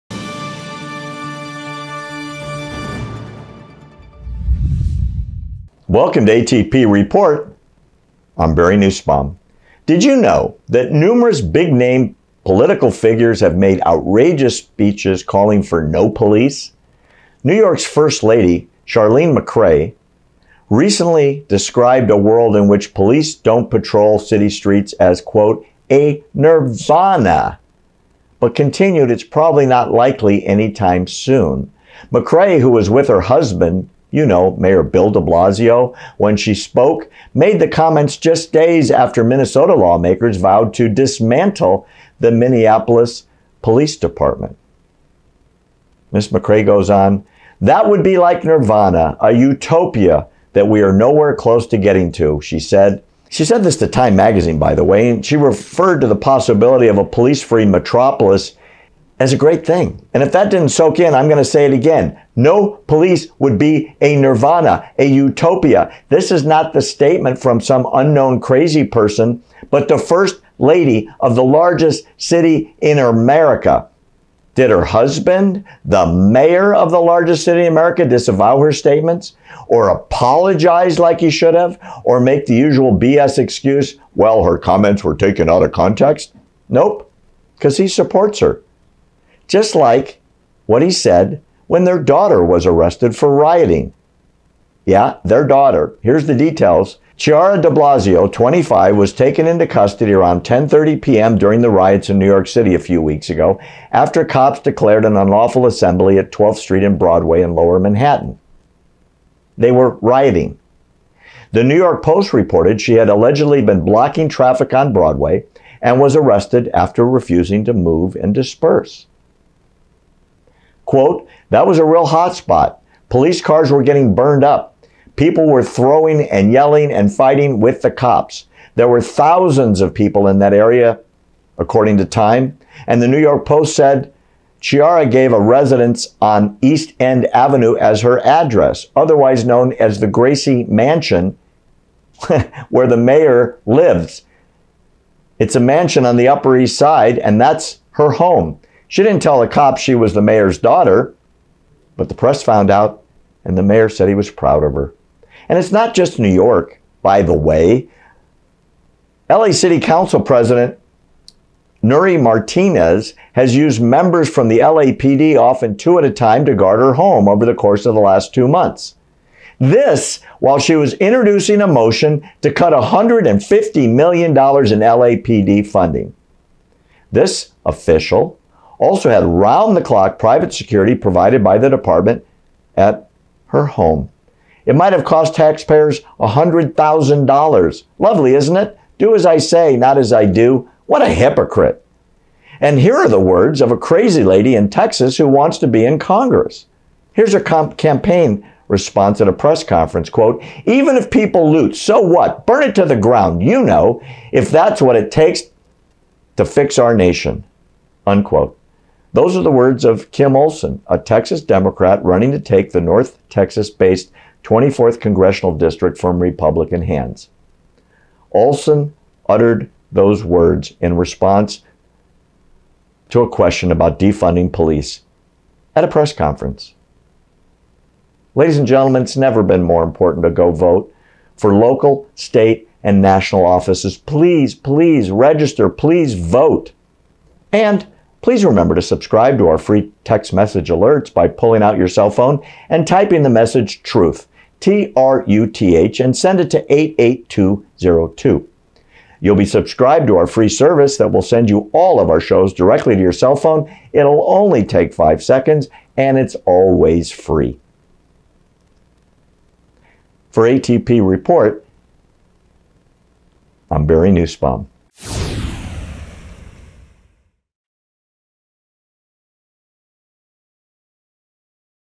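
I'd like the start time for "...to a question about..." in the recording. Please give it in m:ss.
3:43.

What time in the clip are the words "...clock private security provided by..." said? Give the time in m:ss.
2:59.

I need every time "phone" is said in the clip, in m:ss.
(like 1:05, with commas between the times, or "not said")
4:02, 4:13.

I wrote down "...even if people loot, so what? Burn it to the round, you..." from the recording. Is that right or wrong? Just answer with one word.
wrong.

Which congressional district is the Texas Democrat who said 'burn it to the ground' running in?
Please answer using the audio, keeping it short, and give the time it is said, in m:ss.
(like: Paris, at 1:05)
24th, at 3:34.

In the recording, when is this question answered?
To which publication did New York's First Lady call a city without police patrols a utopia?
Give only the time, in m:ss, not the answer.
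0:53.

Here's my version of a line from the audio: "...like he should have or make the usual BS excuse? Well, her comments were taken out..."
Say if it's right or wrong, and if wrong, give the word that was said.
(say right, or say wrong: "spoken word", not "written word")
right.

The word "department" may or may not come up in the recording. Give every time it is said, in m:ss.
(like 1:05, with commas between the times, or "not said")
0:43, 3:01.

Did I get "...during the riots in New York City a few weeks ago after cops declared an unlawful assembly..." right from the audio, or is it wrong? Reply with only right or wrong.
right.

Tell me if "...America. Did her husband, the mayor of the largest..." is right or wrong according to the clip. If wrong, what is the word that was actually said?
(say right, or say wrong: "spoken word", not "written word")
right.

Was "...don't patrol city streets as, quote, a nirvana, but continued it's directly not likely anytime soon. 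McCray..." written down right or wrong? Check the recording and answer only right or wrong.
wrong.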